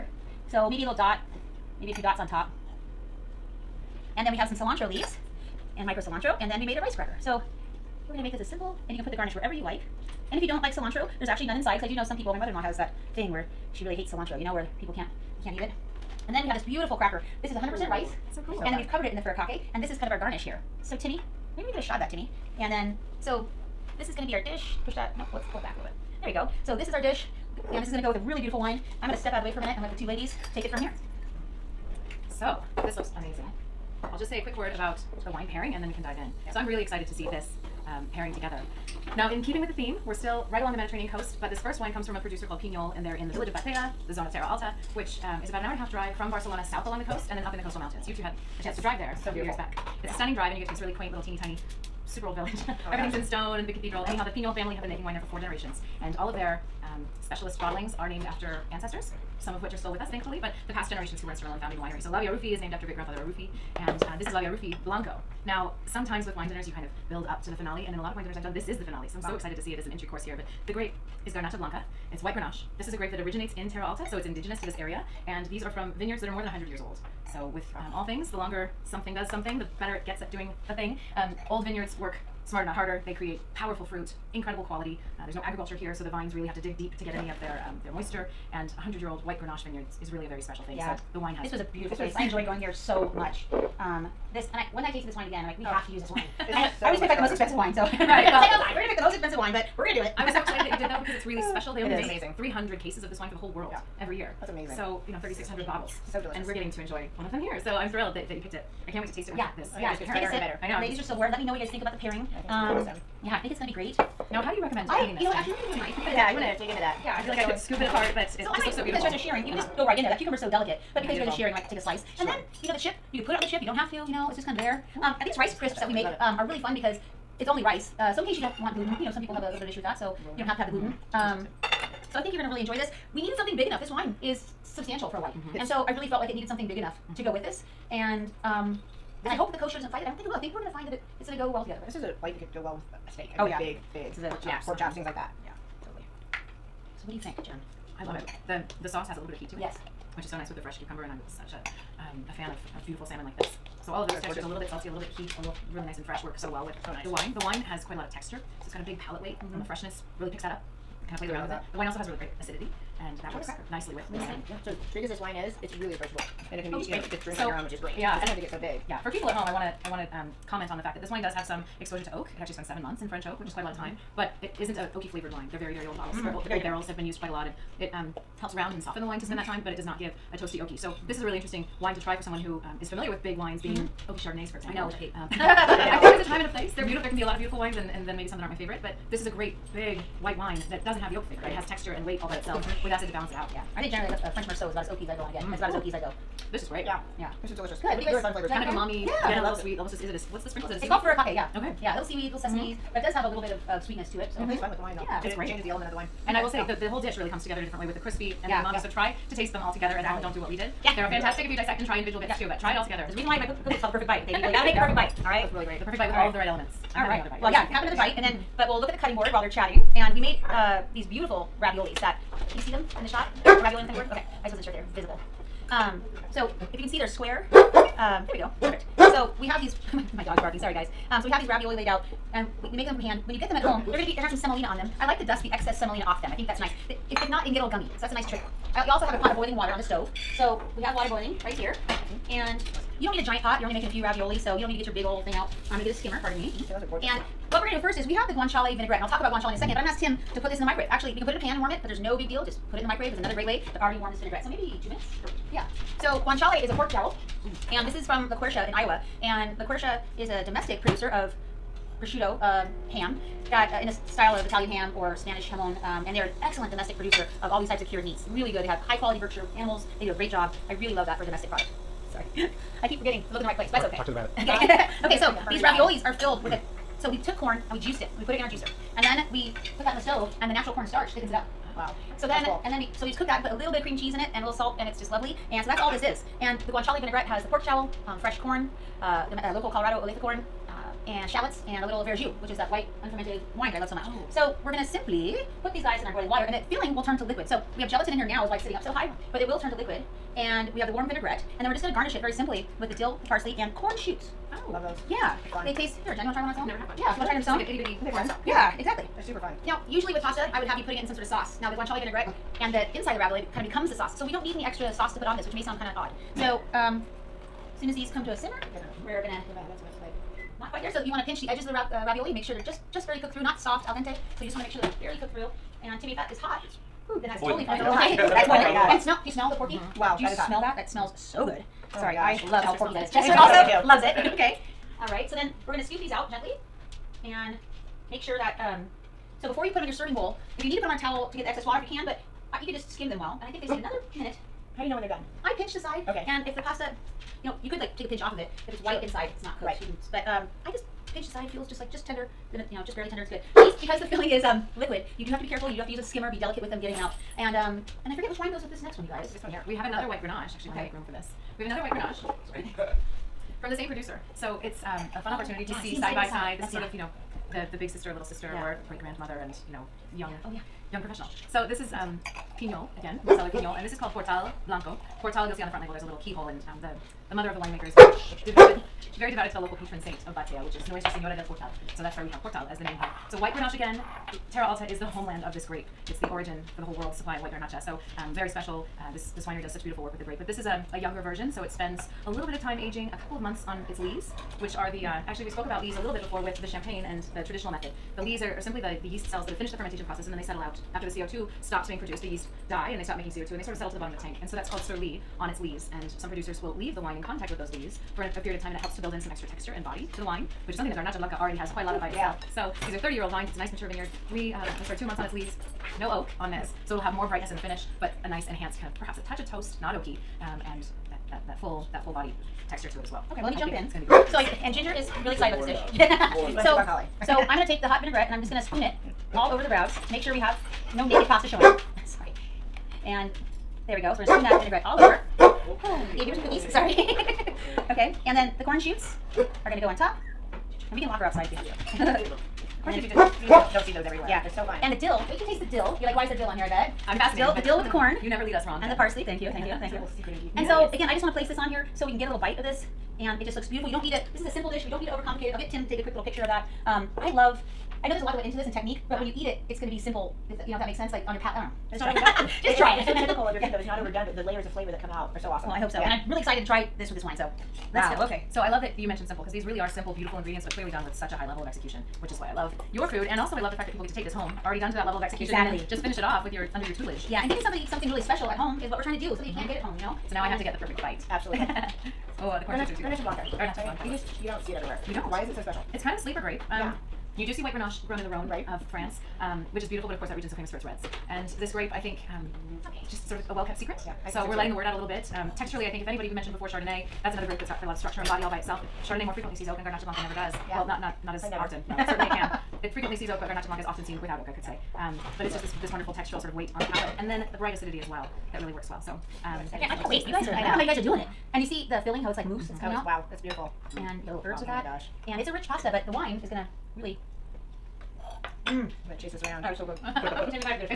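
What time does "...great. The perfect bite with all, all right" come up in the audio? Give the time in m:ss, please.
3:35.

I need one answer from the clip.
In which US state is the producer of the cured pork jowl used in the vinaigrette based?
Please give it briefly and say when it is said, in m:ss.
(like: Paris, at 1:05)
Iowa, at 4:18.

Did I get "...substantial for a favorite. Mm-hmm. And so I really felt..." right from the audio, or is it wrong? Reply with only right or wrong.
wrong.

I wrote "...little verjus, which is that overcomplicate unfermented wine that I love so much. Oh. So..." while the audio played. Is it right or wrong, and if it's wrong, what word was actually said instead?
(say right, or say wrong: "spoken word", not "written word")
wrong: "white", not "overcomplicate".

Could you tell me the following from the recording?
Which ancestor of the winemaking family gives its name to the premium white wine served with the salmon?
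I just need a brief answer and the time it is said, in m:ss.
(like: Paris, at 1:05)
great grandfather Arrufí, at 1:02.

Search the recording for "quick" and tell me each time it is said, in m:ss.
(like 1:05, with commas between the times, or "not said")
0:34, 7:36.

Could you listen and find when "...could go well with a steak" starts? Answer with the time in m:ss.
2:22.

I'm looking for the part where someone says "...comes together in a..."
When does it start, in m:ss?
3:27.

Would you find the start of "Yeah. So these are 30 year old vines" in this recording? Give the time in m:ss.
6:52.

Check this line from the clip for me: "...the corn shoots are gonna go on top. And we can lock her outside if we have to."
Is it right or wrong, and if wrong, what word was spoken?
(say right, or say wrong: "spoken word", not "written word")
right.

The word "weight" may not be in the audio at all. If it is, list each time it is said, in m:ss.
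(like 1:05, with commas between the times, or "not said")
2:39, 3:12, 8:26.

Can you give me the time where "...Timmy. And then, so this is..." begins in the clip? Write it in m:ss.
0:22.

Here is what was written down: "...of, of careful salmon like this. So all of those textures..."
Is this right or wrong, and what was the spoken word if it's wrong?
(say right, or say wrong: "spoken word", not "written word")
wrong: "beautiful", not "careful".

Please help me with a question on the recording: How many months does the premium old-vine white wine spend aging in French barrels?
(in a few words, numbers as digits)
7.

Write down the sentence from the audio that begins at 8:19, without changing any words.
Chardonnay more frequently sees oak, and Garnacha Blanca never does.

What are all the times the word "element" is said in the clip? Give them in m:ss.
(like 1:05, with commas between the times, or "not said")
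3:25, 3:36.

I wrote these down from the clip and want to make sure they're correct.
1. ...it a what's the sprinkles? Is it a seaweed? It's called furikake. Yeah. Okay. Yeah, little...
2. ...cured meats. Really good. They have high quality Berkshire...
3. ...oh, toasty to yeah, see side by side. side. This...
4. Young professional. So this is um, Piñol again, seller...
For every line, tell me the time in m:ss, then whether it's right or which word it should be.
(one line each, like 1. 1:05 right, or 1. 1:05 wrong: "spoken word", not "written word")
1. 3:20 right
2. 4:27 right
3. 6:05 wrong: "opportunity", not "toasty"
4. 6:10 right.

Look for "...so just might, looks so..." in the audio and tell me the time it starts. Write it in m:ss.
1:58.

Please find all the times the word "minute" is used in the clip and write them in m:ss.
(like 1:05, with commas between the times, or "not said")
0:29, 4:14, 5:44.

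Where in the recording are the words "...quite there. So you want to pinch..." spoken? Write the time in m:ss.
5:20.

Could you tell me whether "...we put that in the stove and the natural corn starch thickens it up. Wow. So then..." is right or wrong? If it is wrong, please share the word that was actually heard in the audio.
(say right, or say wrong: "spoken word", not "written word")
right.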